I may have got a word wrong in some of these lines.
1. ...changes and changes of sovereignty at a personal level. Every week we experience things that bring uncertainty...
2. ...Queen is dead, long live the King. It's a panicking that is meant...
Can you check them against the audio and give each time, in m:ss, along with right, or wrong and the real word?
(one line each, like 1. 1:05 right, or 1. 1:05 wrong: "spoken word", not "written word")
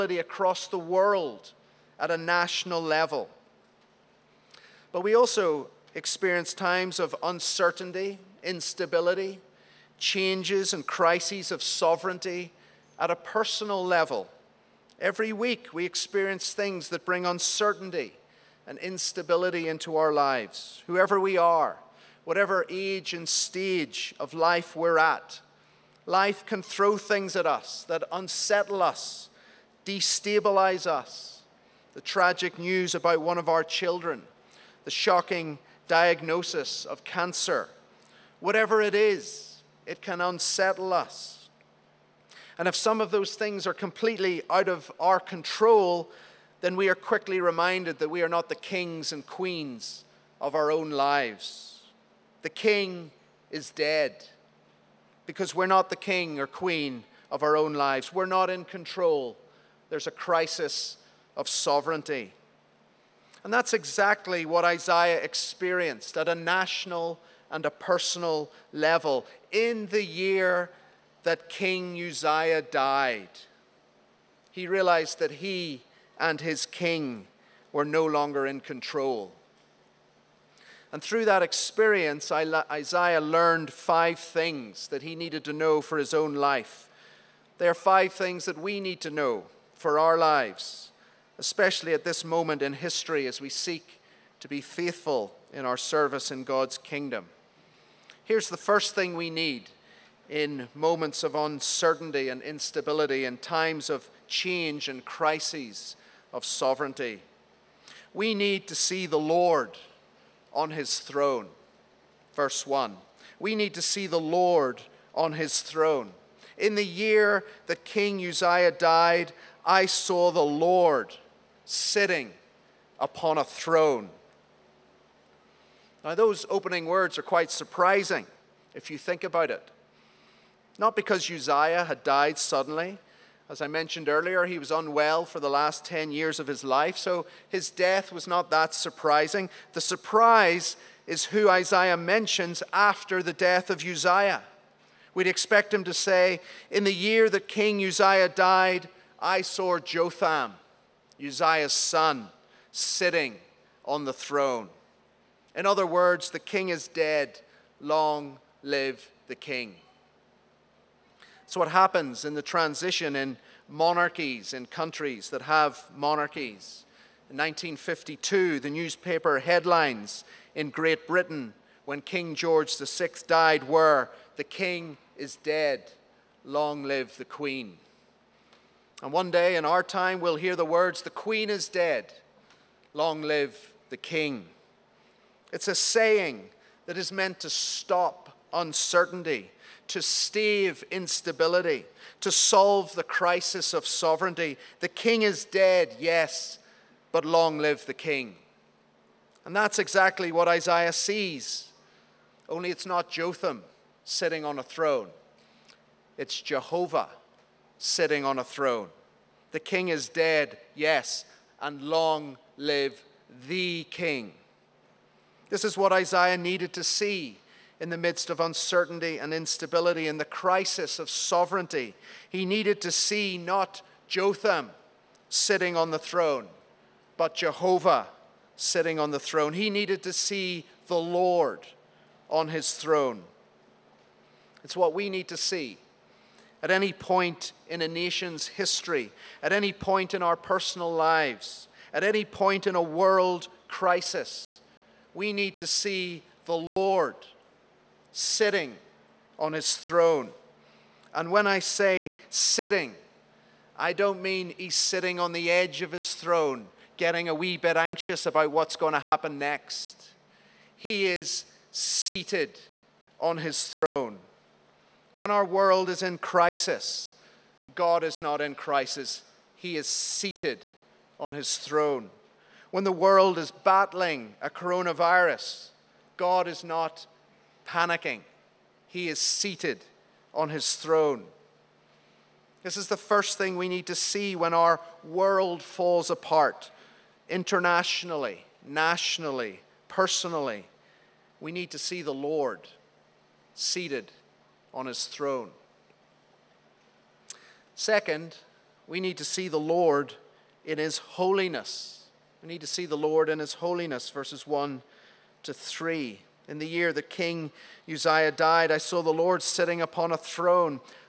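1. 0:09 wrong: "crises", not "changes"
2. 3:01 wrong: "saying", not "panicking".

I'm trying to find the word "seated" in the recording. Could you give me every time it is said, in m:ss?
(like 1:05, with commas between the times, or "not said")
4:21, 4:29, 4:39, 4:53.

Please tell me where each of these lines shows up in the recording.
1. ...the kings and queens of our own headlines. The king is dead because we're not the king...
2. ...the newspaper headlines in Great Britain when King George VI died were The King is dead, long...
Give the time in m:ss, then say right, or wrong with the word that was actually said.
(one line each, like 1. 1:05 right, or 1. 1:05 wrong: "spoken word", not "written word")
1. 0:48 wrong: "lives", not "headlines"
2. 2:48 right.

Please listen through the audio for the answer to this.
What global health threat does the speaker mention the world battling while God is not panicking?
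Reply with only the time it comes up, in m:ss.
4:34.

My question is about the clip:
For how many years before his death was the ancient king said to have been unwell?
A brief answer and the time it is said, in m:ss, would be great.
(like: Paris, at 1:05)
10 years, at 2:15.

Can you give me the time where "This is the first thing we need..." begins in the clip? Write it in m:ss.
4:42.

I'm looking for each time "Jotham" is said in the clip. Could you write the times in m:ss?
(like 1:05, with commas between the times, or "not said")
2:29, 3:23, 3:44.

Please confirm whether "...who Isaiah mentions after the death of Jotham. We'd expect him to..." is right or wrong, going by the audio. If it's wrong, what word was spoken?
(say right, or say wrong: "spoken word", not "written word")
wrong: "Uzziah", not "Jotham".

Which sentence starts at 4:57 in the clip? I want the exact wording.
Second, we need to see the Lord in his holiness.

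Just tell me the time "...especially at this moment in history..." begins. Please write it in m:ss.
1:31.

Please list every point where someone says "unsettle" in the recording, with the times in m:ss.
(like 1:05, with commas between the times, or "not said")
0:28, 0:40.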